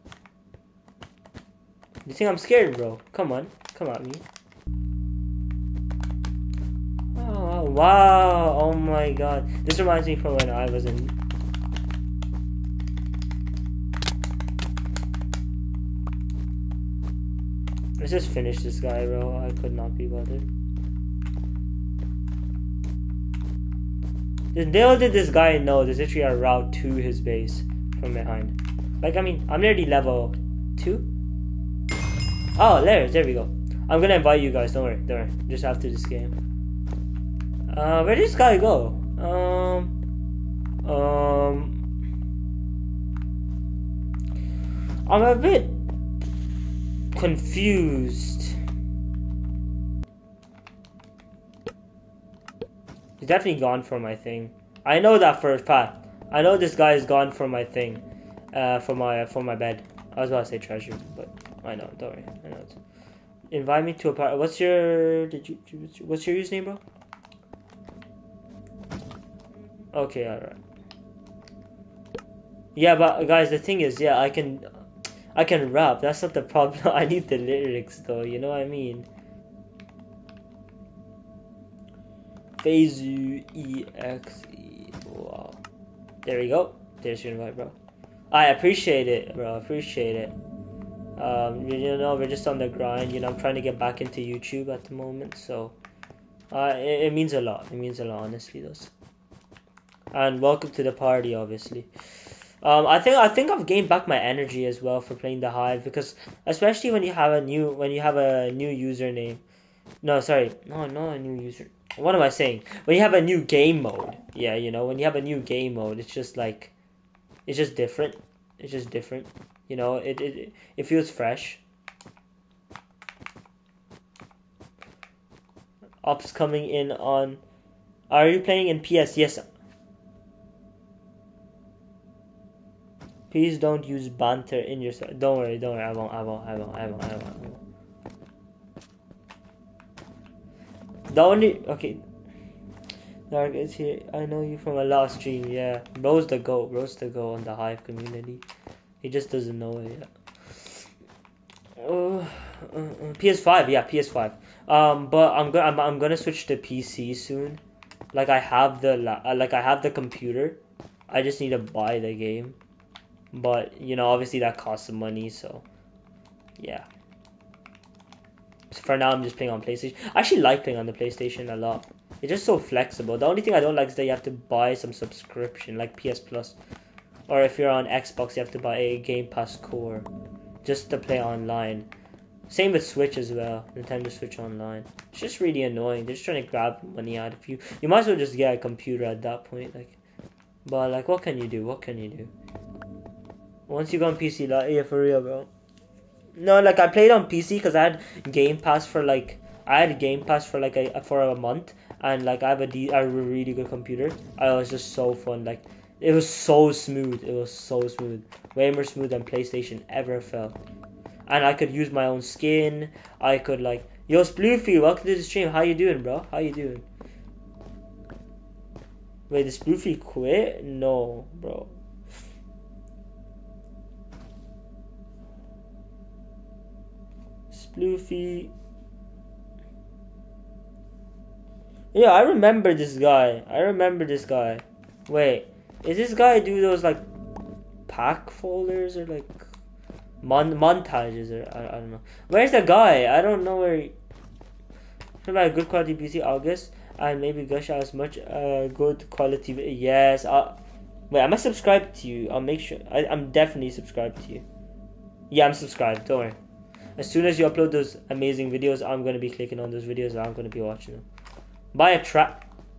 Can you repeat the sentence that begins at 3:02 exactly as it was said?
Same with Switch as well, Nintendo Switch Online.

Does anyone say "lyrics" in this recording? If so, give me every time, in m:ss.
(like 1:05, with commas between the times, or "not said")
1:17.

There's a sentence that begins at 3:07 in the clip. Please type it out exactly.
You might as well just get a computer at that point, like.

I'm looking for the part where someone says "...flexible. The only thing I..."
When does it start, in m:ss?
2:52.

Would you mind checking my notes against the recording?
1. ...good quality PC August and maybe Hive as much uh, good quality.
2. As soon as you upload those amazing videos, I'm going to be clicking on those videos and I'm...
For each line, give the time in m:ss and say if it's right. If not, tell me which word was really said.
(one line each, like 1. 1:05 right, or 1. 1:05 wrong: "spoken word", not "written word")
1. 4:05 wrong: "Gush", not "Hive"
2. 4:16 right.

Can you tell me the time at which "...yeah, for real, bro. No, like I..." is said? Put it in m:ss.
3:14.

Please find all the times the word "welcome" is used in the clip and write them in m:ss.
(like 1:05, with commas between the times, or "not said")
1:40, 3:34.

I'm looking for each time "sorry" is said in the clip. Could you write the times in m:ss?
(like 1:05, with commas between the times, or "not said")
1:50.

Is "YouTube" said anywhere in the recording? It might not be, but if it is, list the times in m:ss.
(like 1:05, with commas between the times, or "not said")
1:34.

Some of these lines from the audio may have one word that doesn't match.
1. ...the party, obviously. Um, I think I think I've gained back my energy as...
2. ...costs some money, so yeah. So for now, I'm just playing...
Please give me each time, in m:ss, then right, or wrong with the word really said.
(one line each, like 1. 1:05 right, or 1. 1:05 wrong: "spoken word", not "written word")
1. 1:40 right
2. 2:44 right.